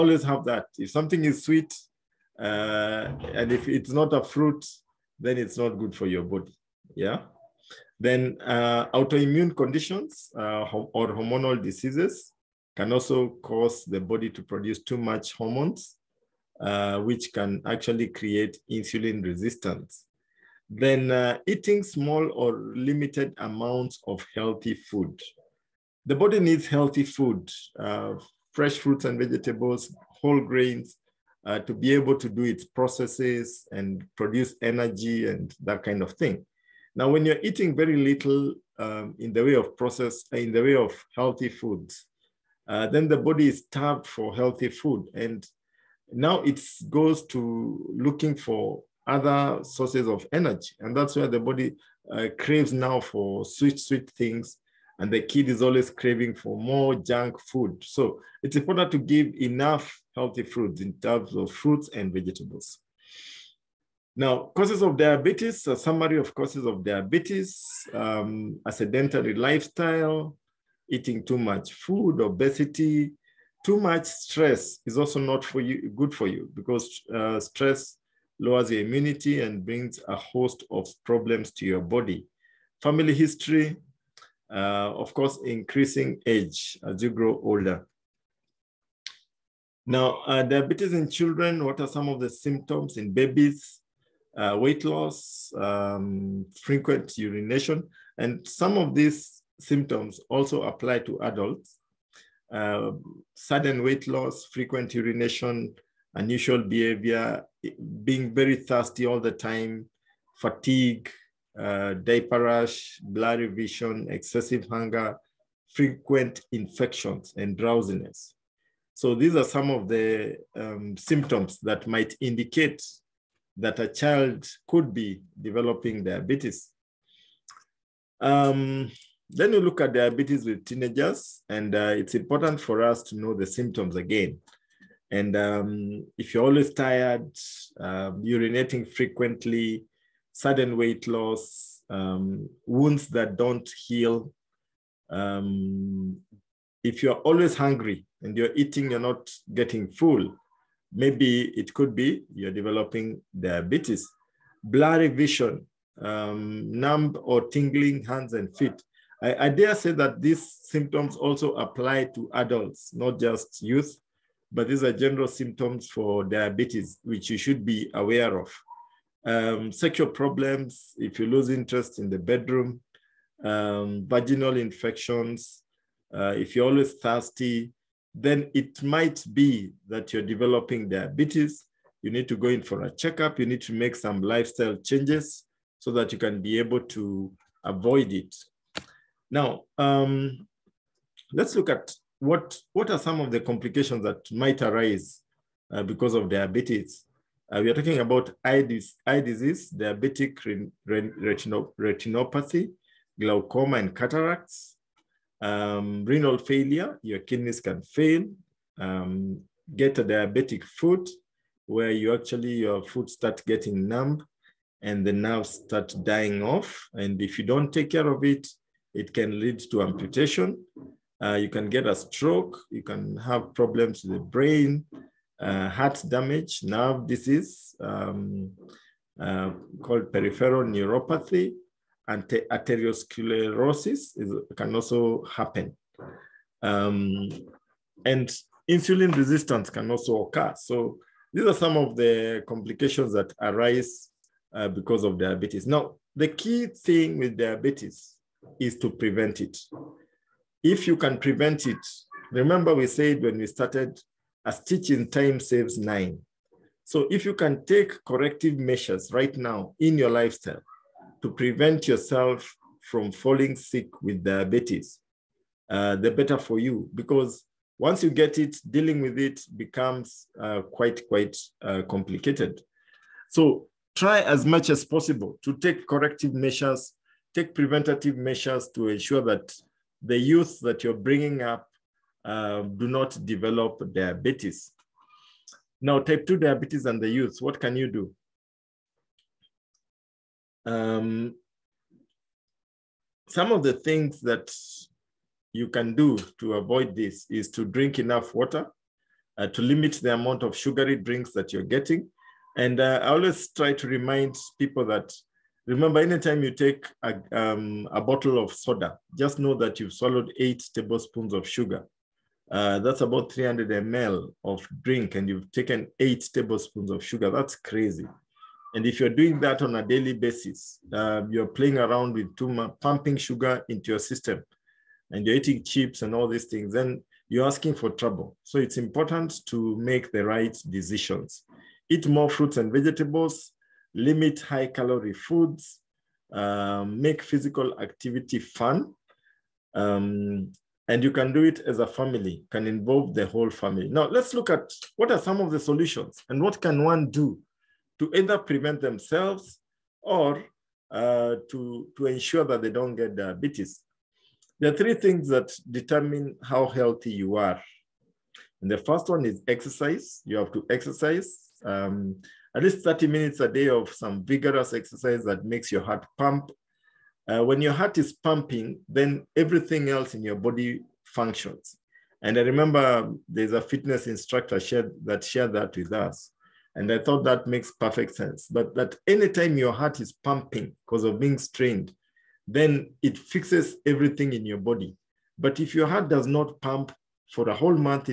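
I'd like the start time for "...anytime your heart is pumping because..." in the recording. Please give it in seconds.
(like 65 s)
379 s.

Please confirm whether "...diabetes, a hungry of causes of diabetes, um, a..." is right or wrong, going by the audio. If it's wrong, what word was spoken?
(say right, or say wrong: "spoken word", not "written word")
wrong: "summary", not "hungry".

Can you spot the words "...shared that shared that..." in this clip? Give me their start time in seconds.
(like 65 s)
374 s.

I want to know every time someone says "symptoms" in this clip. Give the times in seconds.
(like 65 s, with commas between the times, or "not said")
92 s, 99 s, 120 s, 133 s, 160 s, 165 s.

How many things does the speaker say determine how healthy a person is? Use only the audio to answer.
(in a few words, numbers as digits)
3.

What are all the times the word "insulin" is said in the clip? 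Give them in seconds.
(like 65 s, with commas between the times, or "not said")
18 s, 238 s.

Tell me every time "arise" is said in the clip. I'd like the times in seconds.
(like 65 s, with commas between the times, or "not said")
194 s, 243 s.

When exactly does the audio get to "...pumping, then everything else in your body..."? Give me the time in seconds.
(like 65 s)
368 s.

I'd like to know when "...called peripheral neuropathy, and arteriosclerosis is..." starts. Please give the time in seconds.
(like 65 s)
229 s.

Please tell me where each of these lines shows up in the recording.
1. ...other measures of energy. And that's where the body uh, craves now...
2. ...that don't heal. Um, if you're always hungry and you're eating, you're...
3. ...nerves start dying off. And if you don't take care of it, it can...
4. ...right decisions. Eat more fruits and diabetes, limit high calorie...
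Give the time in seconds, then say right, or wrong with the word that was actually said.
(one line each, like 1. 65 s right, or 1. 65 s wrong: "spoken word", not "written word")
1. 49 s wrong: "sources", not "measures"
2. 143 s right
3. 215 s right
4. 330 s wrong: "vegetables", not "diabetes".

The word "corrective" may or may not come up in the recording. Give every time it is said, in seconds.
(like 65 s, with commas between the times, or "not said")
258 s, 275 s.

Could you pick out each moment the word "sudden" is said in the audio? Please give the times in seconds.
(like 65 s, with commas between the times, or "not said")
103 s, 140 s.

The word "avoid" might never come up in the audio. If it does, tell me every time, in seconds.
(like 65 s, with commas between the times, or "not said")
187 s, 296 s.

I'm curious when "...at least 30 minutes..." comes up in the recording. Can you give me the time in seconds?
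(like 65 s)
362 s.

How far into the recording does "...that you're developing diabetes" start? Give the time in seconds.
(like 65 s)
179 s.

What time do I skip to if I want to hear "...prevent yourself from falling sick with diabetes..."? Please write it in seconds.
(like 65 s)
261 s.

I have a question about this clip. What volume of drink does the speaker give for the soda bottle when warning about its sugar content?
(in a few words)
300 ml.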